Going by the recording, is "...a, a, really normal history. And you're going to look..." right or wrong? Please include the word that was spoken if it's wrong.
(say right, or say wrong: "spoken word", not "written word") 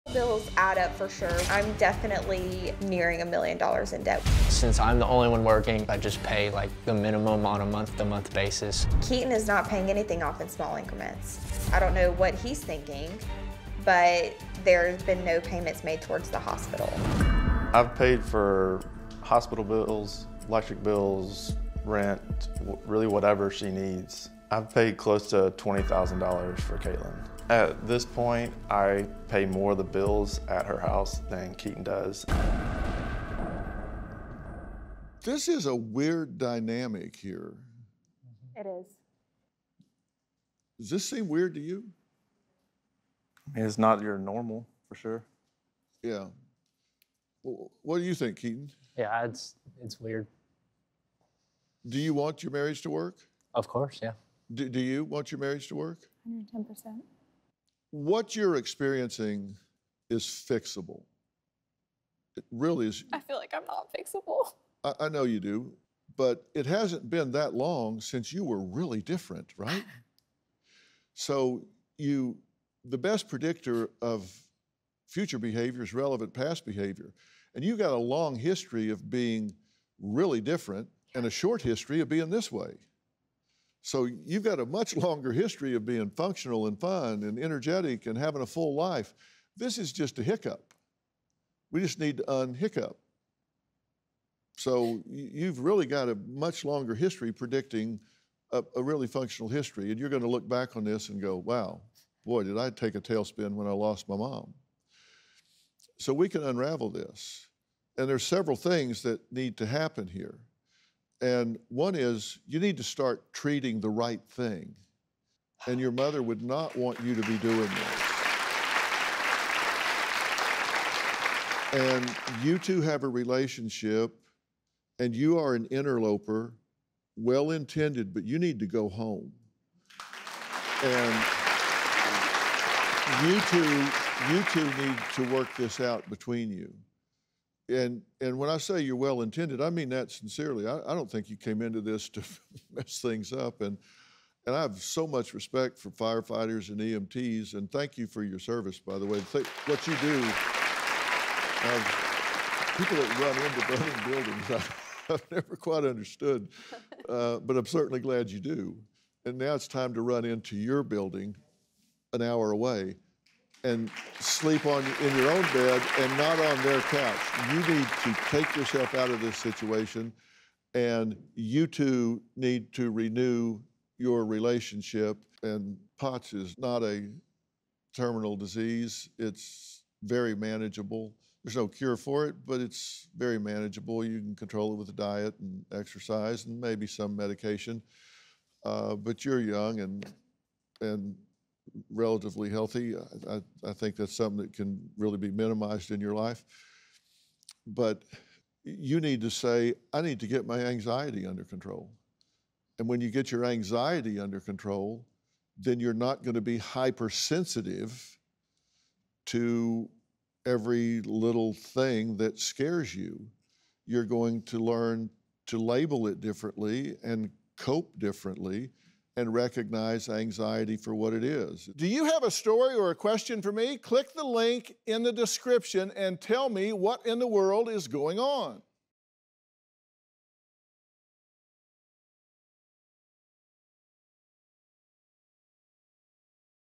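wrong: "functional", not "normal".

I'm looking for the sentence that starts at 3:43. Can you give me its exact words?
Click the link in the description and tell me what in the world is going on.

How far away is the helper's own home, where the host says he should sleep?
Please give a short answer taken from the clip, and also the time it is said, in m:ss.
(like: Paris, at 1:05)
an hour away, at 2:42.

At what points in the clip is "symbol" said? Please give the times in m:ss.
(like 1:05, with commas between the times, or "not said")
not said.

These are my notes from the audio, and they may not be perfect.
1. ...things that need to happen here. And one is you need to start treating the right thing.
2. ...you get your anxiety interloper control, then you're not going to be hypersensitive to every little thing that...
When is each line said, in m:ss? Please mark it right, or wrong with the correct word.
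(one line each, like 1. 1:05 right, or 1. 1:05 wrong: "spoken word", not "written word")
1. 1:48 right
2. 3:23 wrong: "under", not "interloper".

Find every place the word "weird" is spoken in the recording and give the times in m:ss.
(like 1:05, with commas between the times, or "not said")
0:35, 0:41, 0:49.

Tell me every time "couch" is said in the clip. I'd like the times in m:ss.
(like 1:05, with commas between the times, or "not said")
2:46.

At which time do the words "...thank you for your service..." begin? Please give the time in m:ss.
2:27.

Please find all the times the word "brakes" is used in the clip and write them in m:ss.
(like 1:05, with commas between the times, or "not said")
not said.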